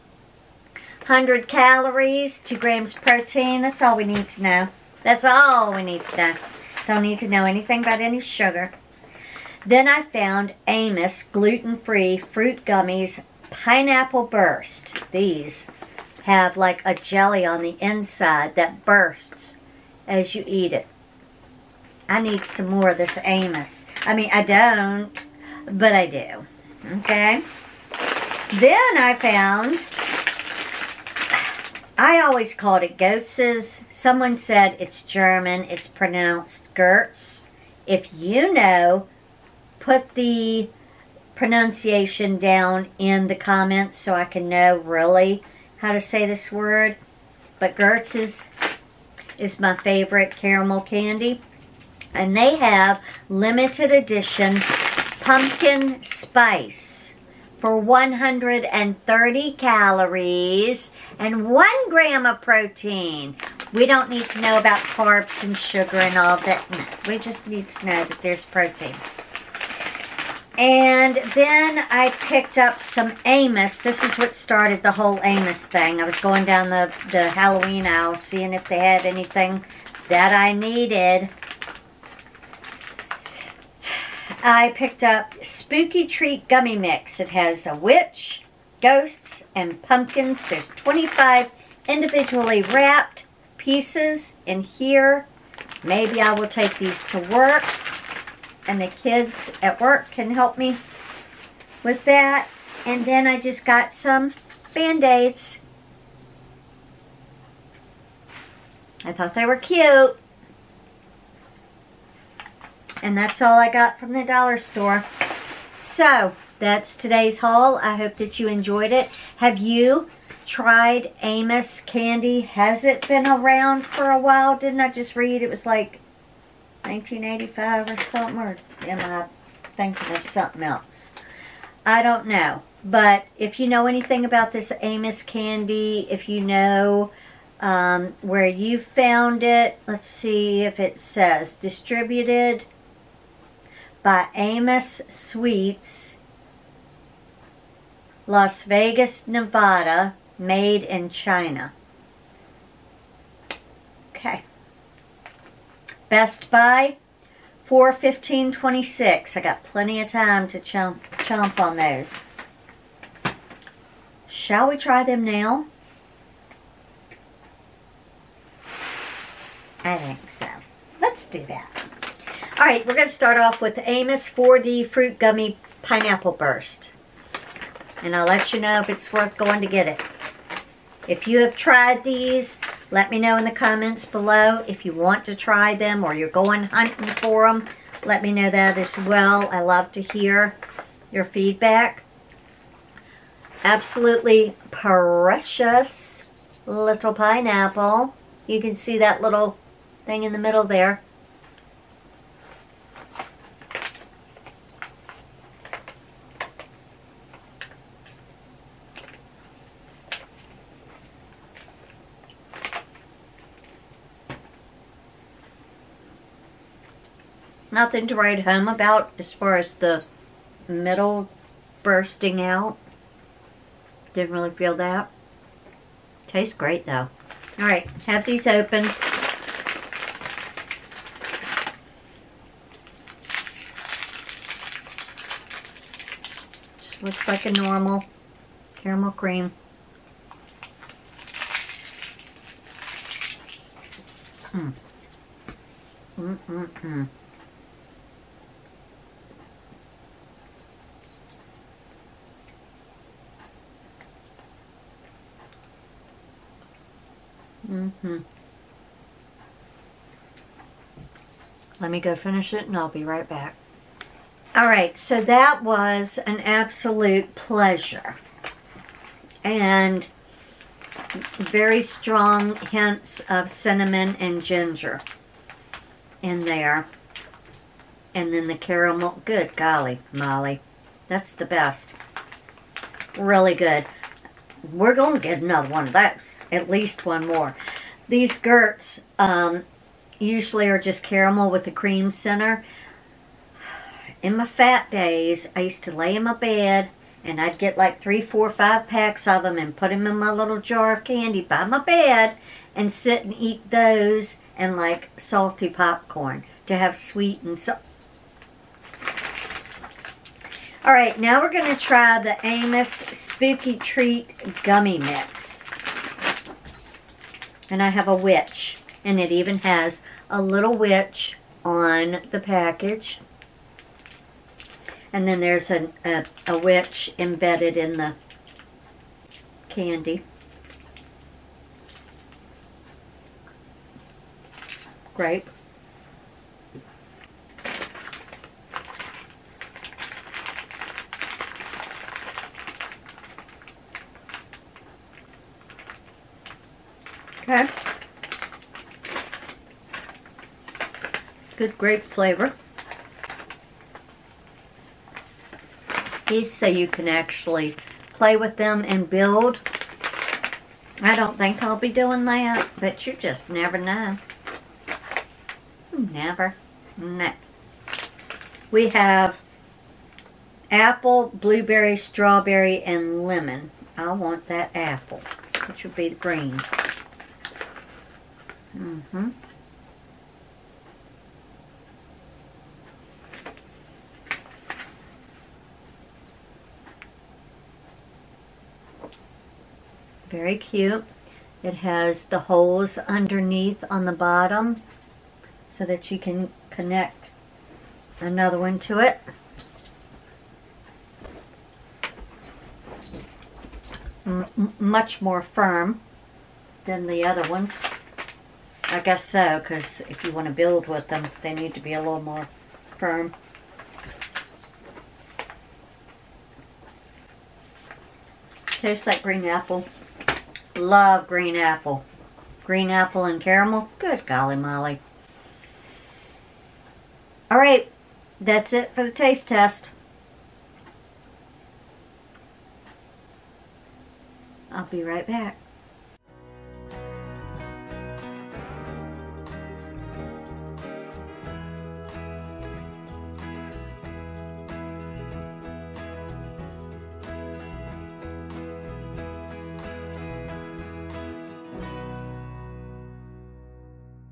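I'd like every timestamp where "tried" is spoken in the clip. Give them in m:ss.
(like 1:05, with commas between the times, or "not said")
2:00, 3:01.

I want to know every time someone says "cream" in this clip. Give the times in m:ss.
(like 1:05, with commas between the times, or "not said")
3:59, 4:51.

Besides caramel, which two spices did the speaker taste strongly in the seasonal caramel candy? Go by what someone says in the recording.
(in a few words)
Cinnamon and ginger.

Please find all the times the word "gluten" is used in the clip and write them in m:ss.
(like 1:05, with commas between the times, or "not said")
0:11.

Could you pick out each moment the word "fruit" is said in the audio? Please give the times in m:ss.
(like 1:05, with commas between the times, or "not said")
0:12, 2:54.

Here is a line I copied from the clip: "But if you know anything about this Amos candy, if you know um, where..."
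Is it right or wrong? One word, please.
right.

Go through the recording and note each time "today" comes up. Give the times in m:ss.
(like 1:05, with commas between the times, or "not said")
1:56.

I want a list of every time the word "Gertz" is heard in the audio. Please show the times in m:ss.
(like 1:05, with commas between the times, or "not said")
0:36, 0:47, 4:48.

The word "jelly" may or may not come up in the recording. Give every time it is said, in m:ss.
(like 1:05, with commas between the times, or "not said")
0:16.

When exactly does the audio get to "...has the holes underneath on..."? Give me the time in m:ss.
6:31.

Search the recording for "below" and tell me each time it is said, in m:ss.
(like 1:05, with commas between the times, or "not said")
3:04.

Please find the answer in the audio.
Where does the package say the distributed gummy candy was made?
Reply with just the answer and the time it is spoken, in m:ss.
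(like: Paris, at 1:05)
China, at 2:31.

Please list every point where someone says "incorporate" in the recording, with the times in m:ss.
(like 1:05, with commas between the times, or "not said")
not said.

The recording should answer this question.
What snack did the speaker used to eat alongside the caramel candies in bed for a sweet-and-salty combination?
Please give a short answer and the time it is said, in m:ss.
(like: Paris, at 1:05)
Salty popcorn, at 5:05.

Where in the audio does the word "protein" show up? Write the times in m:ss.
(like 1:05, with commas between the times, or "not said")
0:02, 1:02, 1:08.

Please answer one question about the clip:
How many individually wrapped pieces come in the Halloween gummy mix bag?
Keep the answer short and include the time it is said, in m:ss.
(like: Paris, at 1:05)
25, at 1:30.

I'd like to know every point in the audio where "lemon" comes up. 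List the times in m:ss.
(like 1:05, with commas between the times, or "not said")
6:13.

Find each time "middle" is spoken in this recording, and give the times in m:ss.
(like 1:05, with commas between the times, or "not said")
3:20, 3:40.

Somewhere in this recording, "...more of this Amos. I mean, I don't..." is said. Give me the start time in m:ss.
0:22.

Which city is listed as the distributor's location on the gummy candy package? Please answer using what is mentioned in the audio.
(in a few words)
Las Vegas, Nevada.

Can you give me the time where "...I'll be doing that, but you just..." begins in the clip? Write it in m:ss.
6:01.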